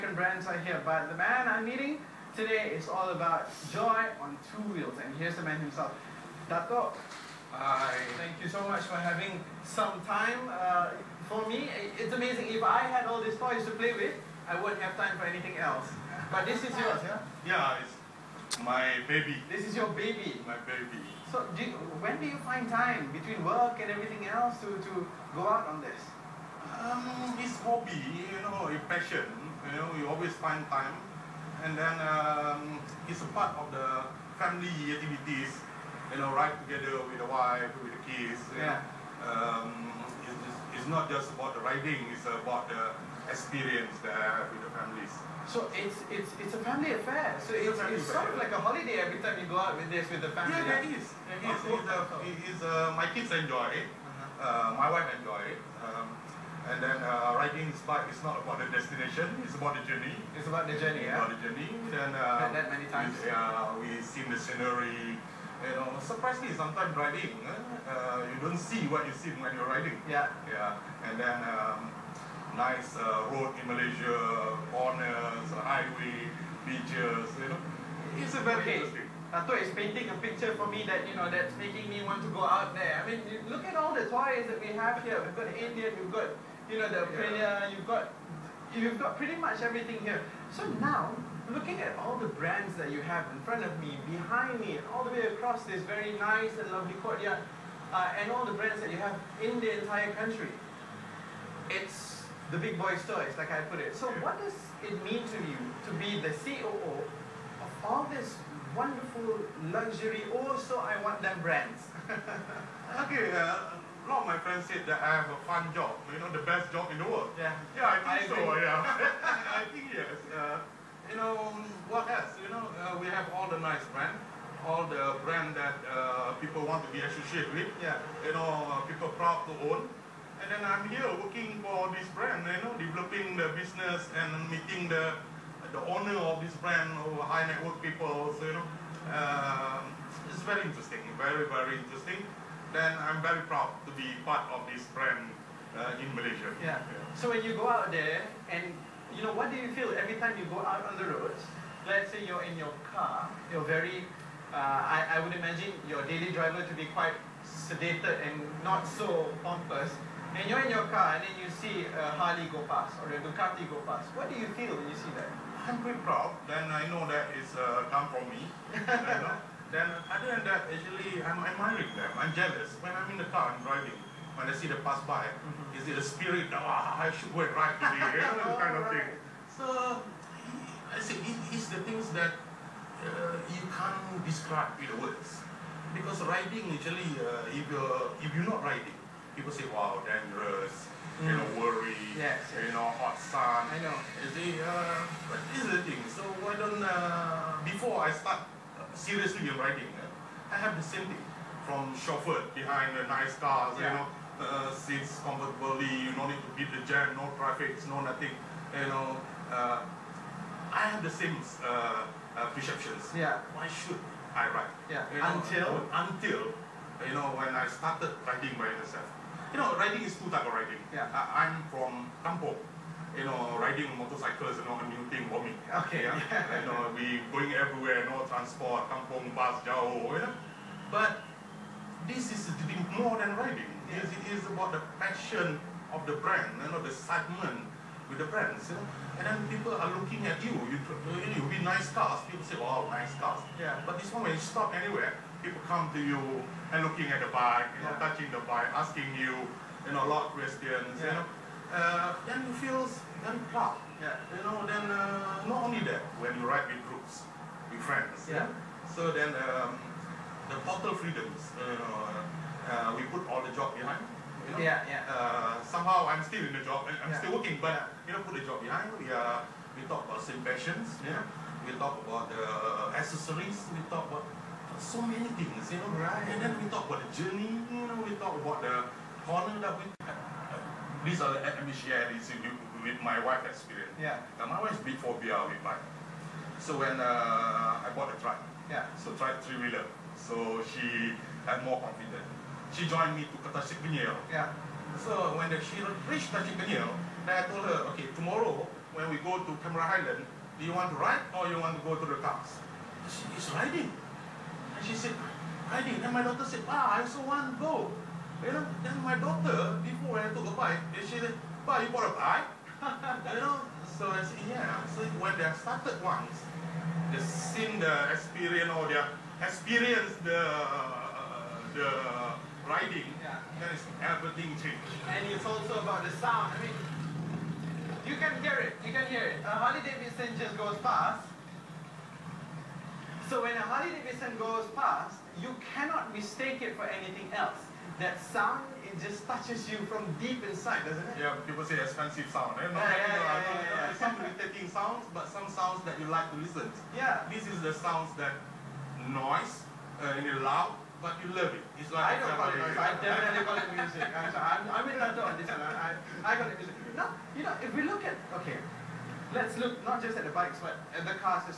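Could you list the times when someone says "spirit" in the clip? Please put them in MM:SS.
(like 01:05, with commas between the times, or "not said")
02:56.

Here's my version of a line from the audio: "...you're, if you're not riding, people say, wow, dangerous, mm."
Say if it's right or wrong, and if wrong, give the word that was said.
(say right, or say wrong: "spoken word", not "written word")
right.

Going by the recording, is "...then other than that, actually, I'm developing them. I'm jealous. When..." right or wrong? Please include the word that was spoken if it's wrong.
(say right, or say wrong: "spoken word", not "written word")
wrong: "admiring", not "developing".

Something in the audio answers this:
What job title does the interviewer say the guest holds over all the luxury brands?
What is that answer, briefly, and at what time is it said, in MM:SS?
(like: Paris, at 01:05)
COO, at 01:46.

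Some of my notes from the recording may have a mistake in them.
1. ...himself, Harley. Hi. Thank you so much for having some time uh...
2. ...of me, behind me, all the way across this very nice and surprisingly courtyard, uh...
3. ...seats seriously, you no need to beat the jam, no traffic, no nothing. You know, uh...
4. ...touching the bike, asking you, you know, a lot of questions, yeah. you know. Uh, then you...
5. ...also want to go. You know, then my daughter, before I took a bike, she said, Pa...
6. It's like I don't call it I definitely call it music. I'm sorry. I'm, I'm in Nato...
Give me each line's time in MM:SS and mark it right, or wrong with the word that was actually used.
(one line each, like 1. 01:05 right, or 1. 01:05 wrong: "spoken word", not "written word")
1. 00:05 wrong: "Dato", not "Harley"
2. 01:33 wrong: "lovely", not "surprisingly"
3. 03:24 wrong: "comfortably", not "seriously"
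4. 04:07 right
5. 05:07 right
6. 05:51 right.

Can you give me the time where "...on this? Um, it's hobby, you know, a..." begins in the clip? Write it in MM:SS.
00:25.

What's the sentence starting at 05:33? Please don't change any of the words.
So when a Harley Davidson goes past, you cannot mistake it for anything else.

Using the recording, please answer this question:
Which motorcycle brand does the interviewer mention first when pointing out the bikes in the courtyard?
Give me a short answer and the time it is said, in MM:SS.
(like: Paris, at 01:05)
Indian, at 01:25.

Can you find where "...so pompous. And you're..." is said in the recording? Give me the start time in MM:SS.
02:38.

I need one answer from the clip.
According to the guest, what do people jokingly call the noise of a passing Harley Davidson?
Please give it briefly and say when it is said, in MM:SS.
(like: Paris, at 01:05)
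Expensive sound, at 05:41.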